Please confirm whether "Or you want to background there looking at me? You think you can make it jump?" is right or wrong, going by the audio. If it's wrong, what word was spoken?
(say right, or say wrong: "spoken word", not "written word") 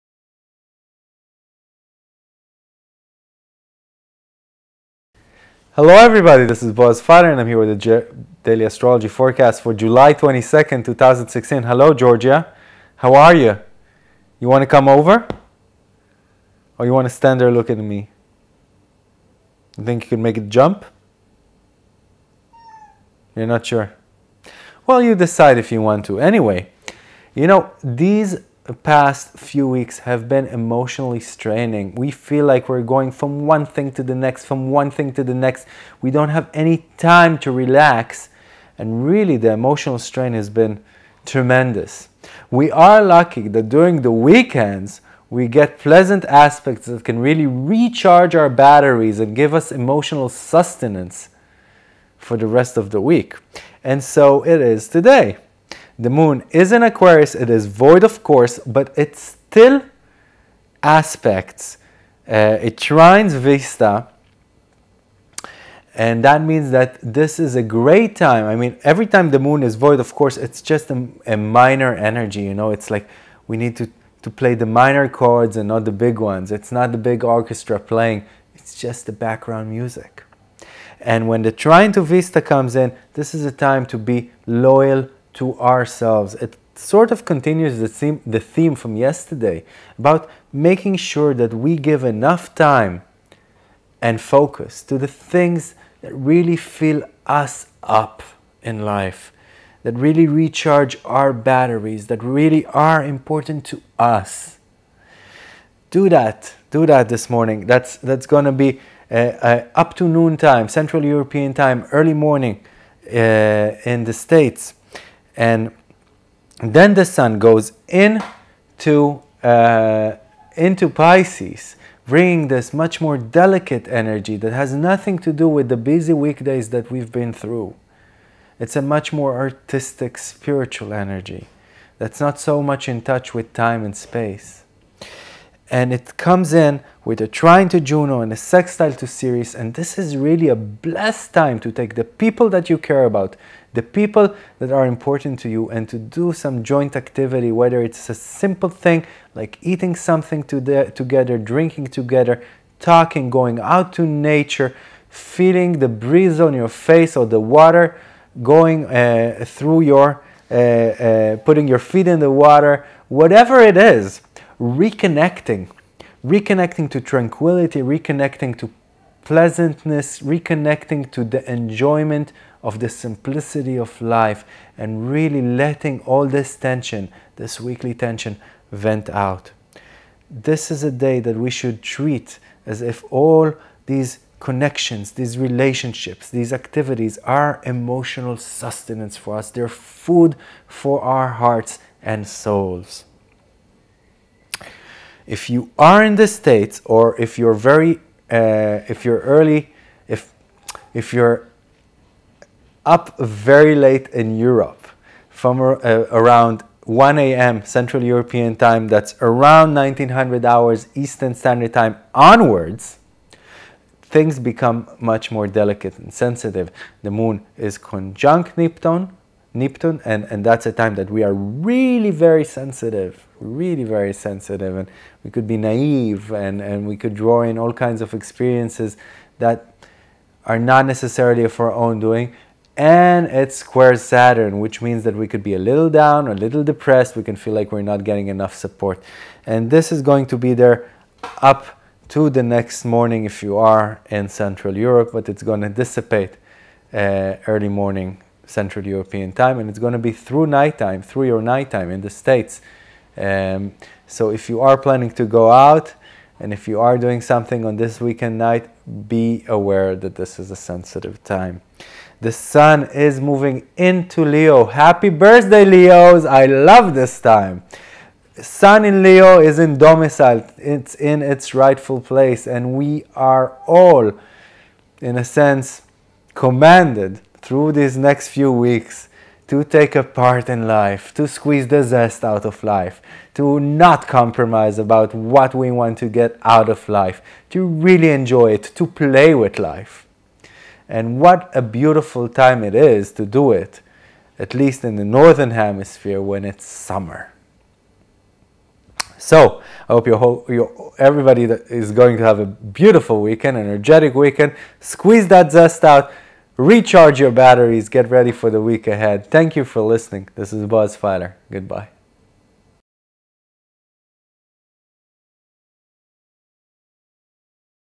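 wrong: "stand", not "background".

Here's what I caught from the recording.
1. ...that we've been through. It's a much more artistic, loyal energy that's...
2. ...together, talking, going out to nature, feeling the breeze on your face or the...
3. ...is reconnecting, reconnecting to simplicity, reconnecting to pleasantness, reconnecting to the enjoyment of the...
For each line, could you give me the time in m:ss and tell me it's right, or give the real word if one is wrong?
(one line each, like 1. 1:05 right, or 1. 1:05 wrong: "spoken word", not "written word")
1. 2:06 wrong: "spiritual", not "loyal"
2. 2:31 right
3. 2:43 wrong: "tranquility", not "simplicity".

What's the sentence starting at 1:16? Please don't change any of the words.
It's not the big orchestra playing, it's just the background music.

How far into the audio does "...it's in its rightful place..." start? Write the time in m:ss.
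4:30.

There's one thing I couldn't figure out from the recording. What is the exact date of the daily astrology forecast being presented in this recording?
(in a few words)
July 22, 2016.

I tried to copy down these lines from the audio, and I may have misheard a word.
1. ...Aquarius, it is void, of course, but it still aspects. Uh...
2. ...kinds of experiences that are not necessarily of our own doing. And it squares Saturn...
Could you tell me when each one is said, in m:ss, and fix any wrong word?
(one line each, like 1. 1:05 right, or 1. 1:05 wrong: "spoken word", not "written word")
1. 0:56 right
2. 3:47 right.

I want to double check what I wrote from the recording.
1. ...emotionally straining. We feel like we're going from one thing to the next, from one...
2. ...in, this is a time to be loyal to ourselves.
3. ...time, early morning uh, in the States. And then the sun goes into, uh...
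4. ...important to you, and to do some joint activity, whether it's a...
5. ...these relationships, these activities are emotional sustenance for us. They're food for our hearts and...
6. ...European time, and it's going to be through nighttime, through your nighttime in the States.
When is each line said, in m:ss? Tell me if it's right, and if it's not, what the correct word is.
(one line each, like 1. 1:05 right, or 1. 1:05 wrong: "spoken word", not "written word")
1. 0:30 right
2. 1:22 right
3. 1:51 right
4. 2:24 right
5. 3:05 right
6. 4:08 right.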